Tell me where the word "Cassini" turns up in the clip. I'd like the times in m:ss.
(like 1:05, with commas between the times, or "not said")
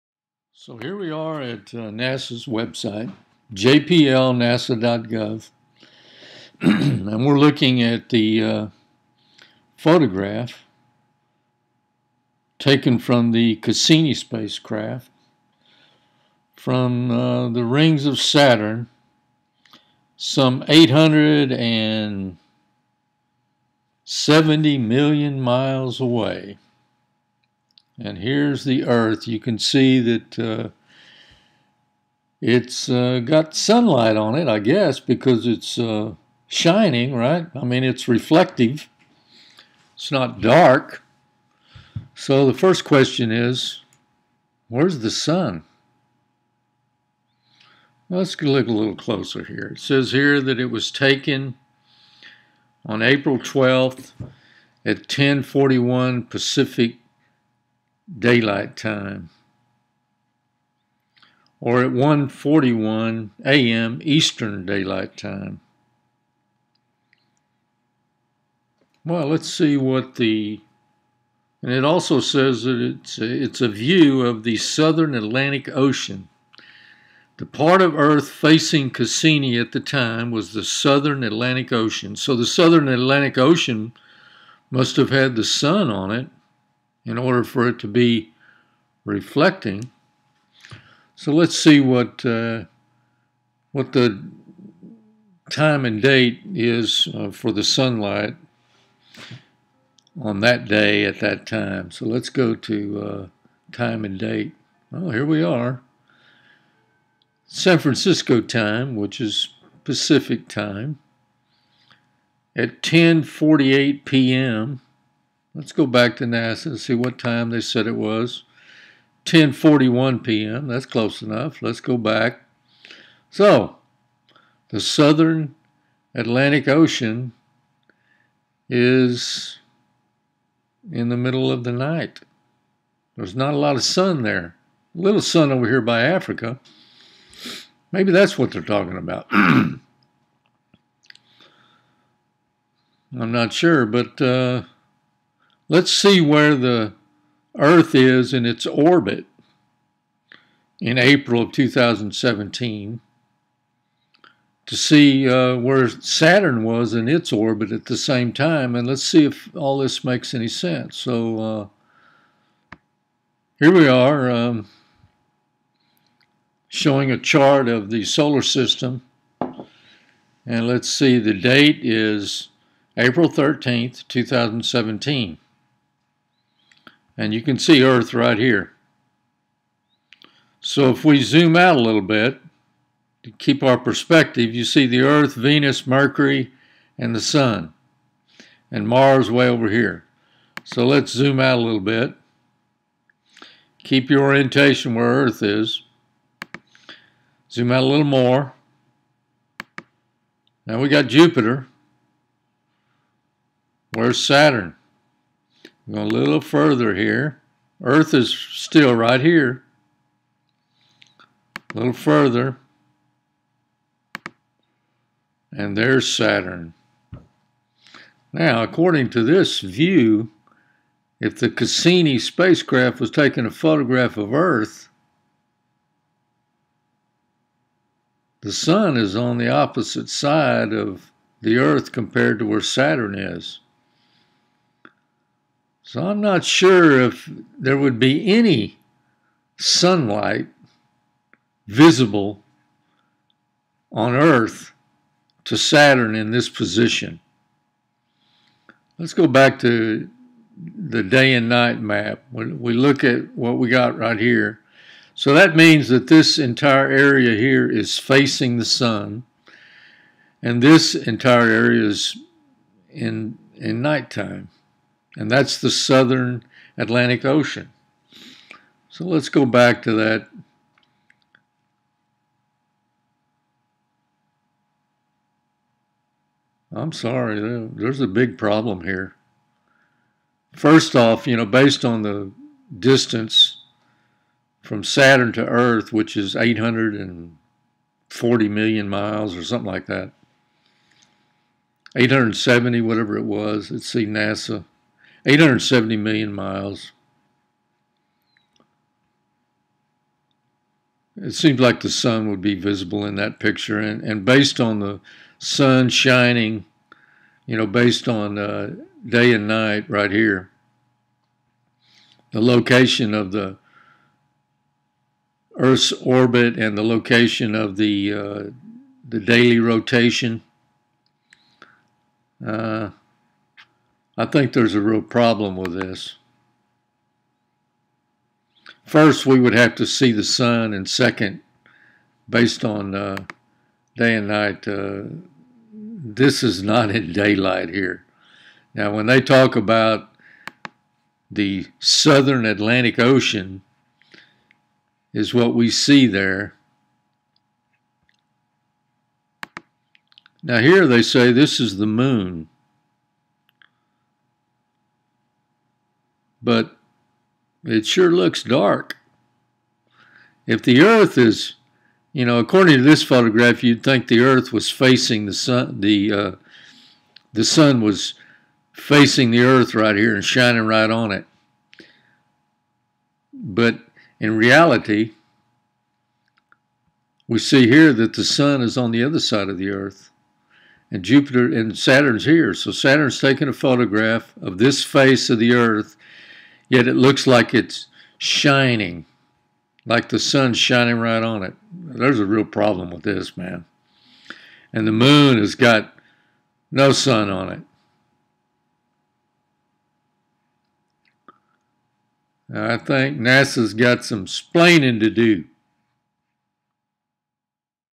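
0:13, 1:18, 3:41.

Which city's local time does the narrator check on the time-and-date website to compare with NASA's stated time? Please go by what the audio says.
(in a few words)
San Francisco.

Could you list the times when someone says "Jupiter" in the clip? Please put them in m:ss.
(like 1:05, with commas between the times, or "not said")
3:21, 6:21.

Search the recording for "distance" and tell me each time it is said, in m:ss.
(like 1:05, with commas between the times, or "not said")
4:42.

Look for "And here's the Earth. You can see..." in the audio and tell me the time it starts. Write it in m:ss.
0:28.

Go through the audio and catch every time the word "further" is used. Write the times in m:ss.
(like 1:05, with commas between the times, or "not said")
3:26, 3:31.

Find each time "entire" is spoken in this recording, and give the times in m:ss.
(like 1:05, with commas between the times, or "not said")
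4:16, 4:20.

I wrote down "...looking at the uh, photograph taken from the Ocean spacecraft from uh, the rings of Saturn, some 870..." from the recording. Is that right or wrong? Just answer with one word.
wrong.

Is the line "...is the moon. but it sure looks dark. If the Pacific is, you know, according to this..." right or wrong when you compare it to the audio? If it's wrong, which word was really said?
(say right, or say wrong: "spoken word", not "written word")
wrong: "Earth", not "Pacific".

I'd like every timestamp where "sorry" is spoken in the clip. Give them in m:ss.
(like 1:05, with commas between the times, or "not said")
4:36.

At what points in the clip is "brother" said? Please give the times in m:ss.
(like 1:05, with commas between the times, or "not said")
not said.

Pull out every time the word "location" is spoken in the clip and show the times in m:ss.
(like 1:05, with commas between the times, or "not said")
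5:12, 5:16.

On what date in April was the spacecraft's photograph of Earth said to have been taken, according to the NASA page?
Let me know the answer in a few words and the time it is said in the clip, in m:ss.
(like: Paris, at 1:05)
April 12th, at 0:53.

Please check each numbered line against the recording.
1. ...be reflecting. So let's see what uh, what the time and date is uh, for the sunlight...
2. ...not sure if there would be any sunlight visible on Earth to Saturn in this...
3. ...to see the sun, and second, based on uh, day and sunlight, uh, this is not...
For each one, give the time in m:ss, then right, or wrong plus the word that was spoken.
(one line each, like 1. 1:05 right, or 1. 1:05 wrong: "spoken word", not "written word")
1. 1:27 right
2. 3:56 right
3. 5:29 wrong: "night", not "sunlight".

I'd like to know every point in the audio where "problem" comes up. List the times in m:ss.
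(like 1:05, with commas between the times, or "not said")
4:38, 5:25, 6:32.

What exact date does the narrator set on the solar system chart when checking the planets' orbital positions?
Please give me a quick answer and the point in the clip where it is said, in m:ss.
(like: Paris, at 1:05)
April 13th, 2017, at 2:52.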